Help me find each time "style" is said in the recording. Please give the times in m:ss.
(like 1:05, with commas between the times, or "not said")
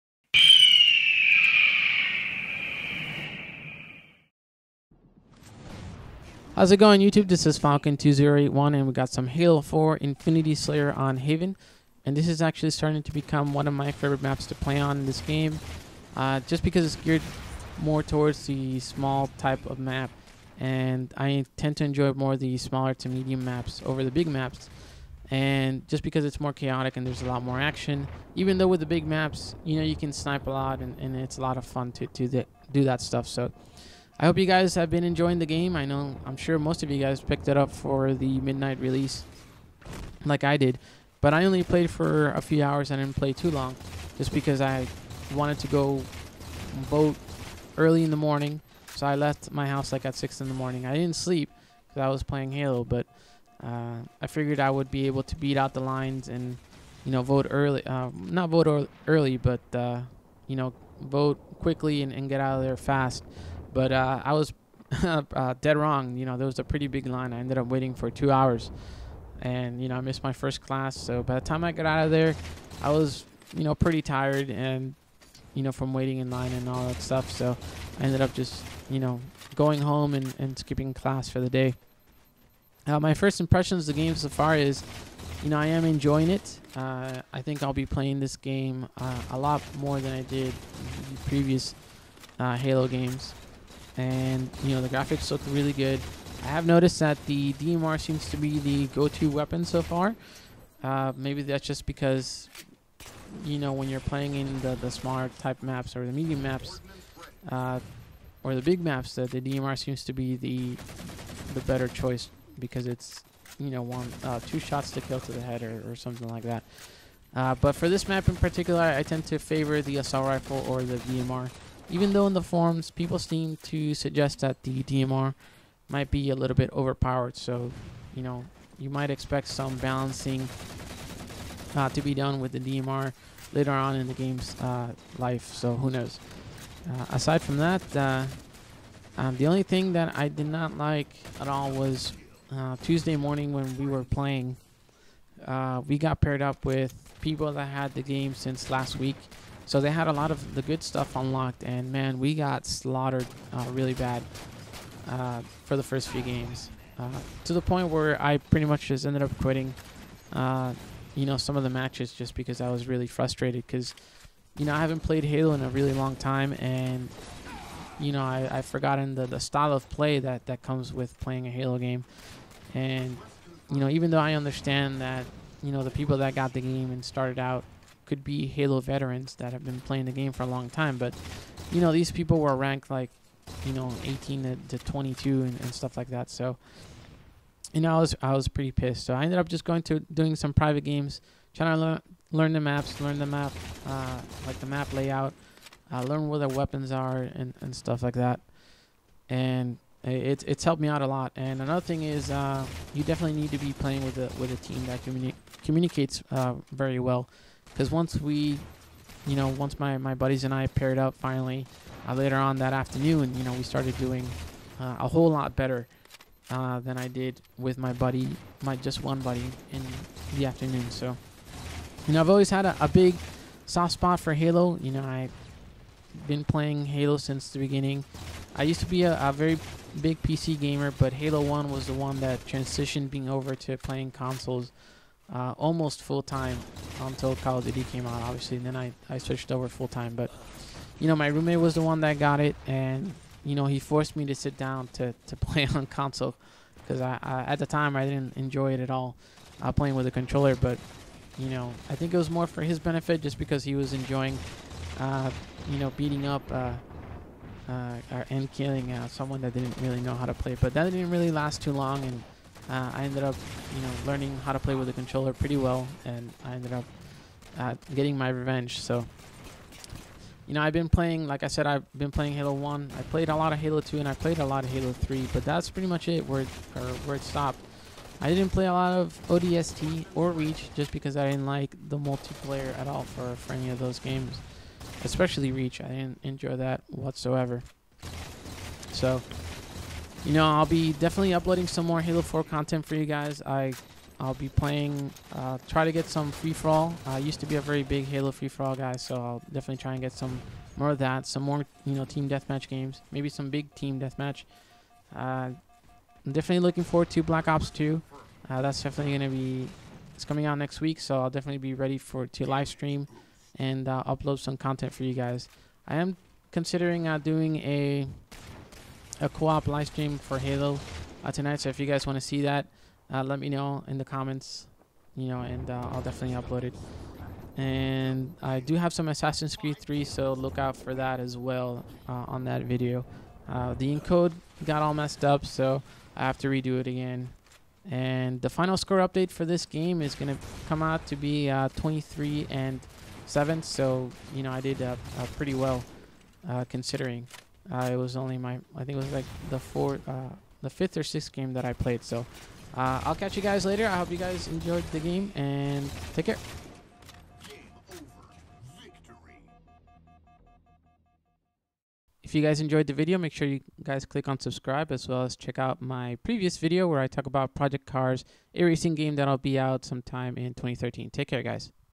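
2:49.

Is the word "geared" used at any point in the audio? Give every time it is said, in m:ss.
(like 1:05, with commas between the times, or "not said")
0:17.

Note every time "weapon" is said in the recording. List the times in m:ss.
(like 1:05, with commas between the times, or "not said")
1:39, 3:16.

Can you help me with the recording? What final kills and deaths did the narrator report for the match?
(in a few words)
23 and 7.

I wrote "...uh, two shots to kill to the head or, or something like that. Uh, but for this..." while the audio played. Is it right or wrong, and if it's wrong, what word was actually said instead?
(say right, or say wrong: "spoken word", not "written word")
right.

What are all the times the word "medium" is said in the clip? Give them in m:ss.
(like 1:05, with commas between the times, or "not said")
0:23, 1:46.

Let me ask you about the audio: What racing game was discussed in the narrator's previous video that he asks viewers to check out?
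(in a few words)
Project Cars.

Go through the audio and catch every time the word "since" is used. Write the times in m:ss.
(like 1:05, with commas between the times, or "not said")
2:28, 3:47.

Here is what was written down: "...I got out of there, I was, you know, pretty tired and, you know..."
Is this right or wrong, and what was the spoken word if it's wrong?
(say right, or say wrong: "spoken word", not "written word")
right.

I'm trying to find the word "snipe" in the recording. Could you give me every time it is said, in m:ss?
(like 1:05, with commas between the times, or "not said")
0:30.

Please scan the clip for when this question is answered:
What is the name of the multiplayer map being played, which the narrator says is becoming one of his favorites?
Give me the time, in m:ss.
0:11.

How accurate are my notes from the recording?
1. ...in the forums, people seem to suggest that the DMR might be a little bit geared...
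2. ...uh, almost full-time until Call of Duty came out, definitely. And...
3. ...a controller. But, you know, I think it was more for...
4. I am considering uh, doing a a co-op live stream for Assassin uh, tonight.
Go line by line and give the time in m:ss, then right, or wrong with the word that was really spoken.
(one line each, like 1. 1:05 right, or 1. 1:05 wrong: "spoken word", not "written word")
1. 2:02 wrong: "overpowered", not "geared"
2. 3:55 wrong: "obviously", not "definitely"
3. 4:10 right
4. 5:15 wrong: "Halo", not "Assassin".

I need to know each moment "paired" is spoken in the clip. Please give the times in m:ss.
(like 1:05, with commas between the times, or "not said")
2:26, 3:30.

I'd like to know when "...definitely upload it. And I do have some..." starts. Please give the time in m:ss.
5:26.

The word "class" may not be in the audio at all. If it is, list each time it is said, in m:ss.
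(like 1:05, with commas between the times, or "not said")
1:10, 1:20.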